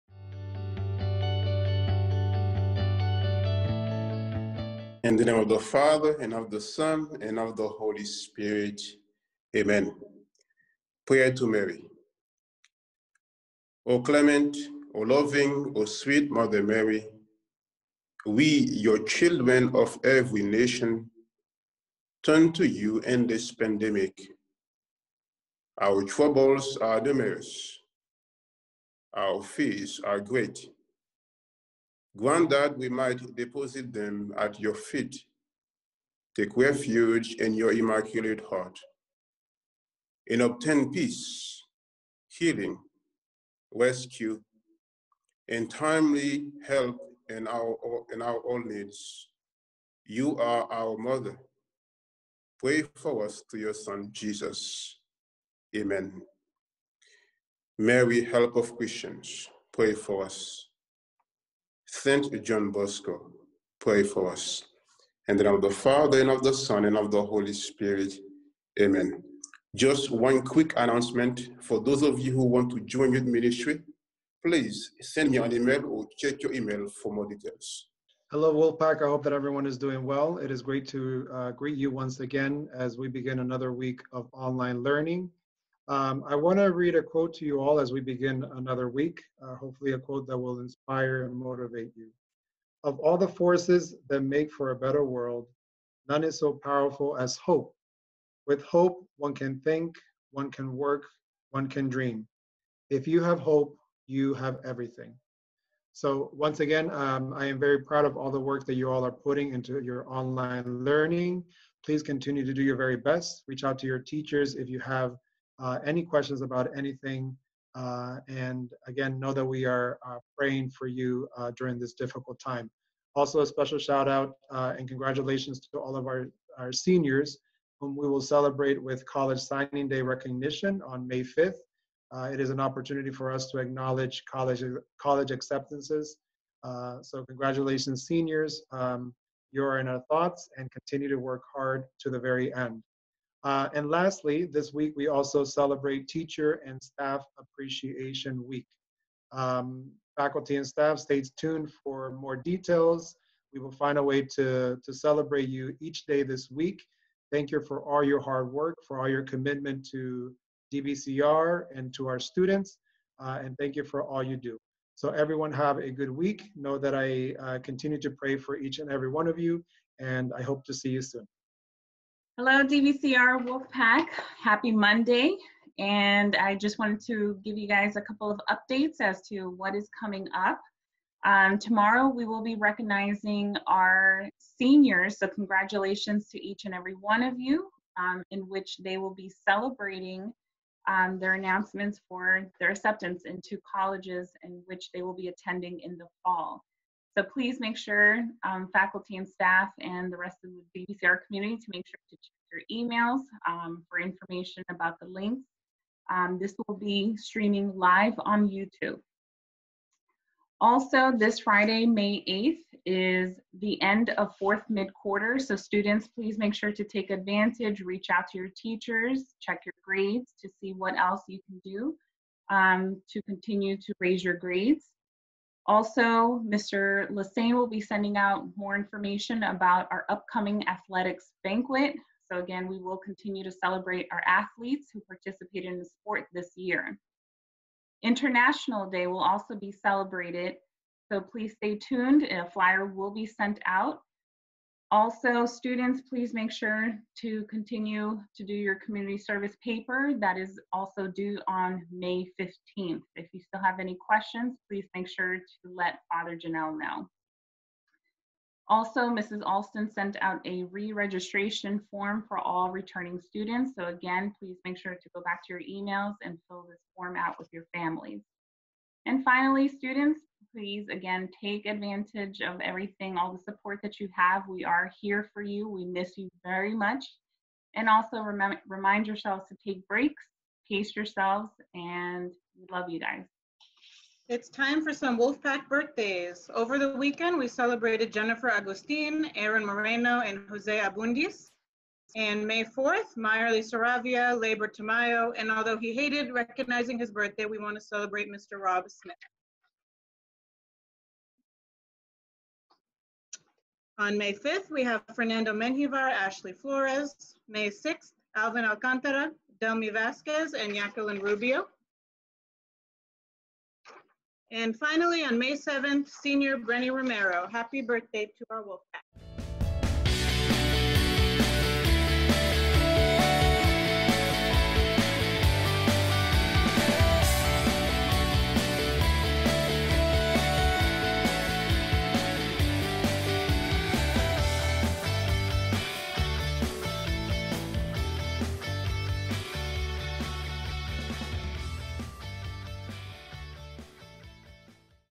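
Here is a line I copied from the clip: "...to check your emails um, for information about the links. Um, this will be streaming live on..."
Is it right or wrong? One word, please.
right.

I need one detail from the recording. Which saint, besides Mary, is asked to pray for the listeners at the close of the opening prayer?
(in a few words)
Saint John Bosco.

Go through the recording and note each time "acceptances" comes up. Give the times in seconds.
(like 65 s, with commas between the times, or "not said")
135 s, 192 s.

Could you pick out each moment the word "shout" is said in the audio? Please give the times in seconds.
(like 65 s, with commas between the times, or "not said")
123 s.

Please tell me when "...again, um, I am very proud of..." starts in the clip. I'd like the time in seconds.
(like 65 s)
106 s.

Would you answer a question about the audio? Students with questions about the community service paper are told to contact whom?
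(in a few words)
Father Janelle.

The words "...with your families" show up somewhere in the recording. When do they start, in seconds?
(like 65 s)
267 s.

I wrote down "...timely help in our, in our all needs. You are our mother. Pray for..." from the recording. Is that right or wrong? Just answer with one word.
right.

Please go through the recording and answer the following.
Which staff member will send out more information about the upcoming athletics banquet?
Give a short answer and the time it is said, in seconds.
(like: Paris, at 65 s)
Mr. Lassane, at 226 s.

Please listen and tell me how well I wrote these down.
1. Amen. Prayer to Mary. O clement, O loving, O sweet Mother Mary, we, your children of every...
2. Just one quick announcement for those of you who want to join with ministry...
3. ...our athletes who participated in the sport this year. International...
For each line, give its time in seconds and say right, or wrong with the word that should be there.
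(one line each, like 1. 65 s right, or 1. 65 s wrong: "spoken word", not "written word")
1. 9 s right
2. 69 s right
3. 234 s right.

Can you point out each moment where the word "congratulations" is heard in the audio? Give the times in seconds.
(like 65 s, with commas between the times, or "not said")
124 s, 137 s, 185 s.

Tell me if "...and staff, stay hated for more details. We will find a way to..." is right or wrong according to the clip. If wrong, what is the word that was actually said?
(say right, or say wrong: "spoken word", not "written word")
wrong: "tuned", not "hated".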